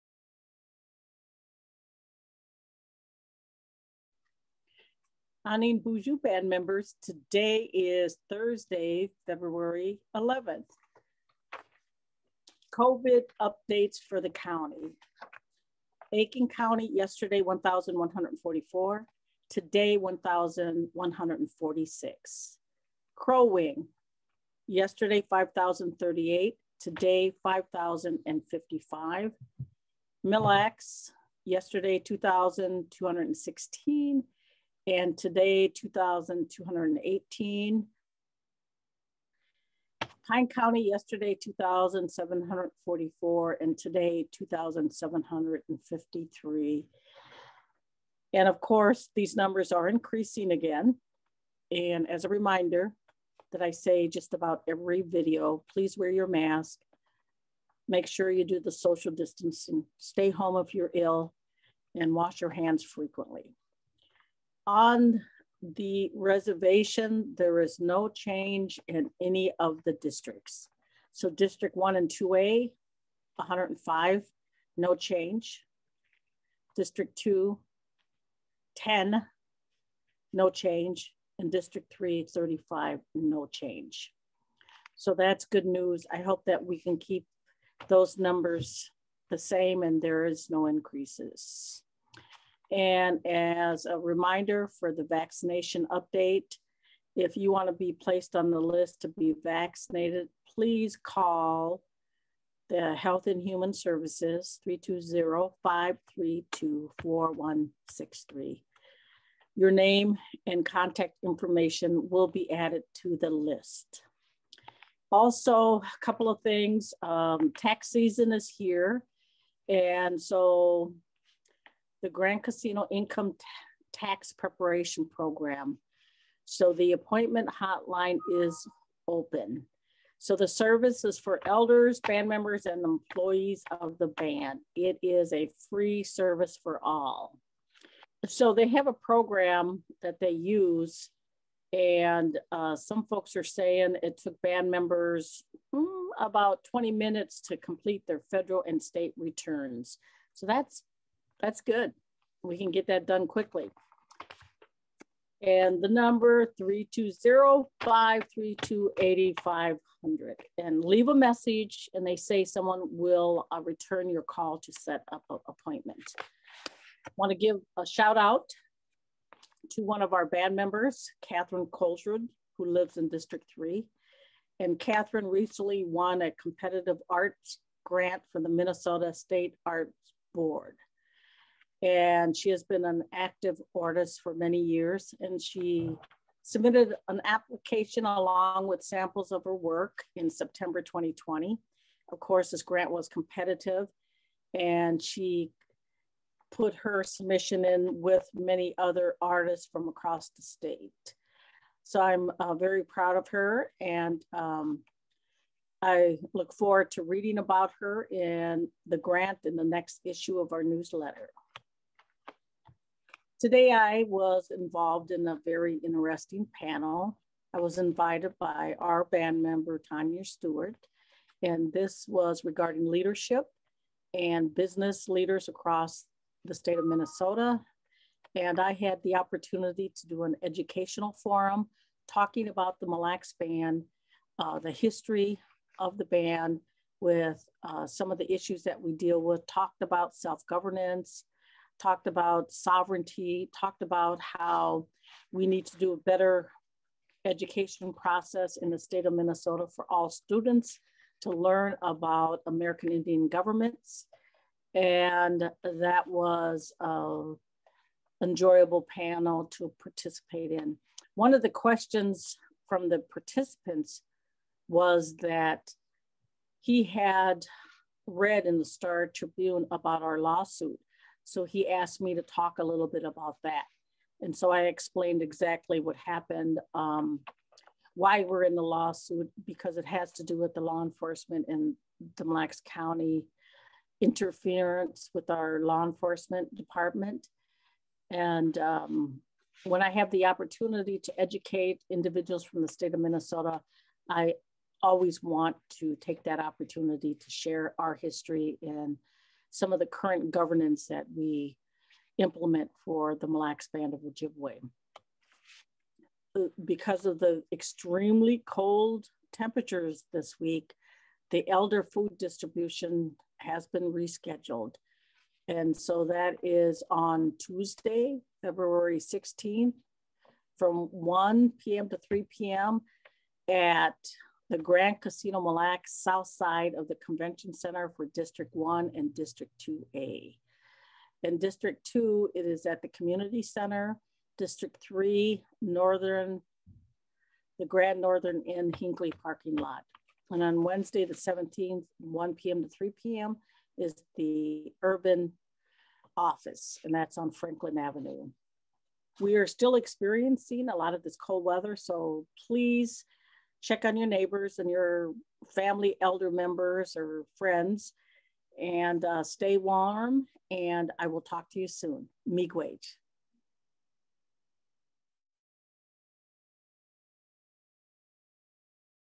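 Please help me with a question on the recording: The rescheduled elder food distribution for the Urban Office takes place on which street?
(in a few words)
Franklin Avenue.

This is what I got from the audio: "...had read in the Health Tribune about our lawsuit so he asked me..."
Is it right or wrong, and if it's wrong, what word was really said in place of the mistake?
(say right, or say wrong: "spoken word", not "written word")
wrong: "Star", not "Health".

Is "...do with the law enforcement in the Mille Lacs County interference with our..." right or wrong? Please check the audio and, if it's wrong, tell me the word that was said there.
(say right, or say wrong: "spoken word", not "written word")
right.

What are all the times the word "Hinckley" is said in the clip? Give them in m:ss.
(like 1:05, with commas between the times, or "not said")
5:38.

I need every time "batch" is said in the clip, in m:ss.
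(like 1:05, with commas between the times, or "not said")
not said.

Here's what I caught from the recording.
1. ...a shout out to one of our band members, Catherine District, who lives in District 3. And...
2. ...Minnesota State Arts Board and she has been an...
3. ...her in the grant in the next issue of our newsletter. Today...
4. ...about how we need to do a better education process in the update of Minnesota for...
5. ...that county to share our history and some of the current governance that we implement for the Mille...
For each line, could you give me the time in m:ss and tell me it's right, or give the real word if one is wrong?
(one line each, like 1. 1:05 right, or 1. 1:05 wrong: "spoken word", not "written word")
1. 2:47 wrong: "Colsrud", not "District"
2. 2:58 right
3. 3:27 right
4. 4:03 wrong: "state", not "update"
5. 4:56 wrong: "opportunity", not "county".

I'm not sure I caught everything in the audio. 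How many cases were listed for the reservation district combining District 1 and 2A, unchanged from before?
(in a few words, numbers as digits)
105.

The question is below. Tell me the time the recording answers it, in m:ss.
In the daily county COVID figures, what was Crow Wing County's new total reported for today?
0:27.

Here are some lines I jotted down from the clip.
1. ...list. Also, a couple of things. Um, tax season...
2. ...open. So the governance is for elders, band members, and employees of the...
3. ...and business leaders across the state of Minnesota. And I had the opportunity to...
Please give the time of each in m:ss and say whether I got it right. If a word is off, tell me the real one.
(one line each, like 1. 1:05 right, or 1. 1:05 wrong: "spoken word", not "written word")
1. 1:53 right
2. 2:09 wrong: "service", not "governance"
3. 3:44 right.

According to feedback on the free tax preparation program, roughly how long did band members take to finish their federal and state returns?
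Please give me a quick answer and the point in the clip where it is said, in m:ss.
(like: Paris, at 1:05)
20 minutes, at 2:26.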